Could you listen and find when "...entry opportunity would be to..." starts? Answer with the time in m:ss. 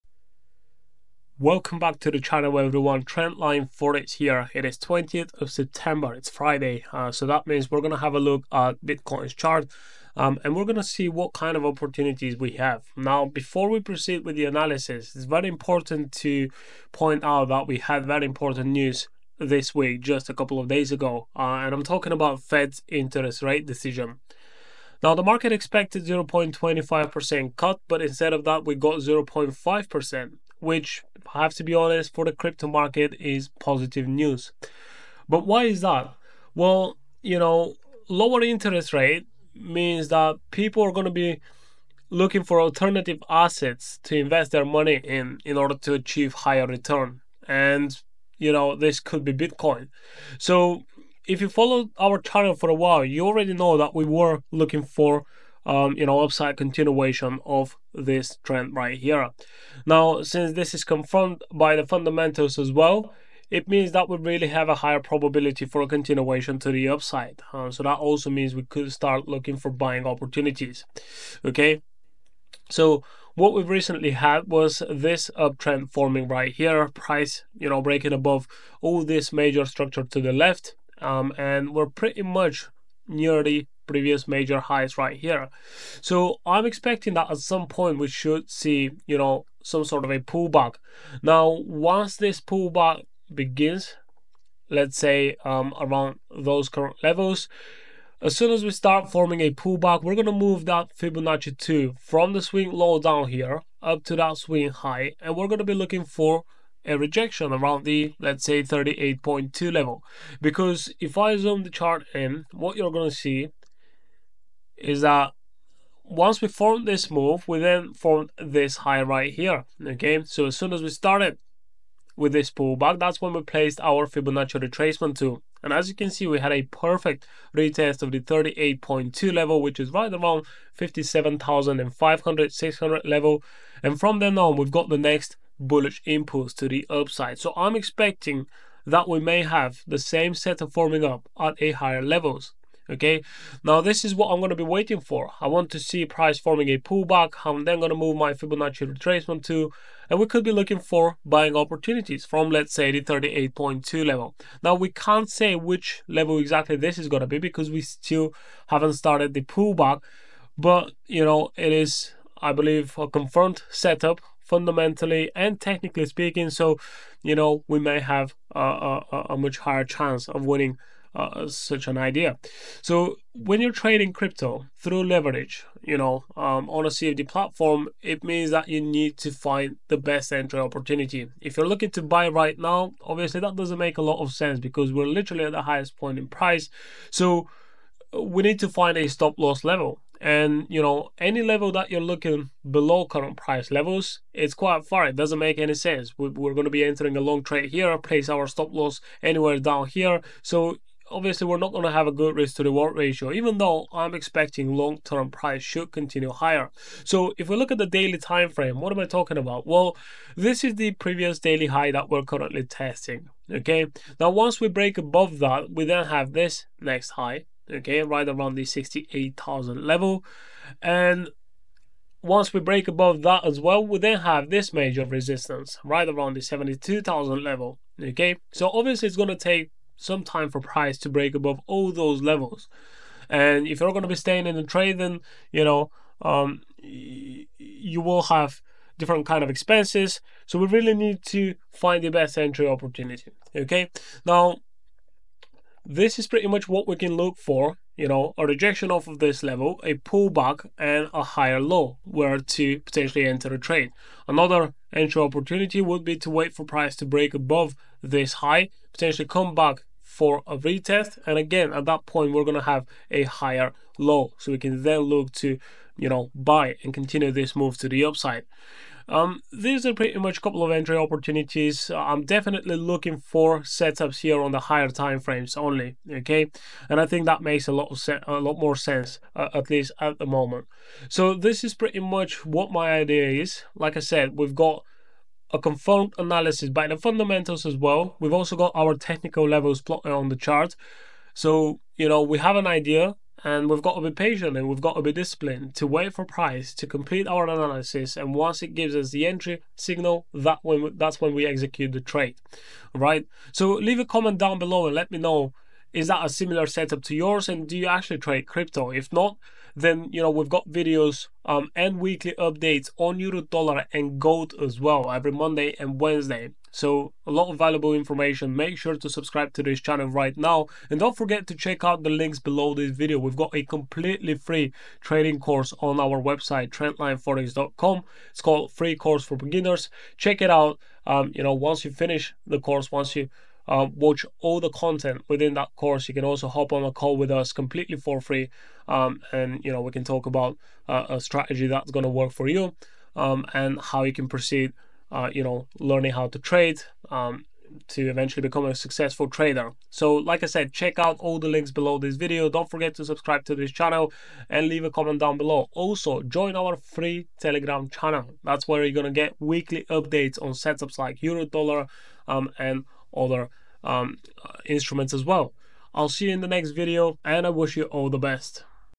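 4:14.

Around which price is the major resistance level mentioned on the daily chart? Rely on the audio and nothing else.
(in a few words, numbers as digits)
72,000.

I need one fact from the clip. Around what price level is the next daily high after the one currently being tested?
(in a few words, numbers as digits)
68,000.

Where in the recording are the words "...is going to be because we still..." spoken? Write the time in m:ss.
2:36.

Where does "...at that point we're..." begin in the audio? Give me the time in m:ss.
4:21.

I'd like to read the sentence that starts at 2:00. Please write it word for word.
So as soon as we started with this pullback, that's when we placed our Fibonacci retracement to.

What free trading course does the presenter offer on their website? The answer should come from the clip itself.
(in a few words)
free course for beginners.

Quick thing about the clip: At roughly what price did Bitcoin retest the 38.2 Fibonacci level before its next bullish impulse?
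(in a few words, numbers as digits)
57,500.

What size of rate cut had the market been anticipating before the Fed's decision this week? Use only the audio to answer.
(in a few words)
0.25%.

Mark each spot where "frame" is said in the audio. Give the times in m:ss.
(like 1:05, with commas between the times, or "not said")
3:28, 4:35.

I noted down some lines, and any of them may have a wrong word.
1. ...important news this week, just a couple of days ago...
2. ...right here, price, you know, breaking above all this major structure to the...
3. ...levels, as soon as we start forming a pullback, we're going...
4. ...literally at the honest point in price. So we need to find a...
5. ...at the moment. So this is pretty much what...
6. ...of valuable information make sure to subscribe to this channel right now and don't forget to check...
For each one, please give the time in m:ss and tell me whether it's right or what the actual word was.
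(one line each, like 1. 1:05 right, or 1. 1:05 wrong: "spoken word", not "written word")
1. 0:18 right
2. 1:16 right
3. 1:37 right
4. 3:05 wrong: "highest", not "honest"
5. 4:39 right
6. 5:17 right.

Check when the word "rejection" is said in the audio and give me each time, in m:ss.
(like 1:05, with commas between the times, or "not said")
1:46, 4:08.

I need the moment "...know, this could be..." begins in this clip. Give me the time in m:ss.
0:48.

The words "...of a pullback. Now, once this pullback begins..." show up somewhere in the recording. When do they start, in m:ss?
1:30.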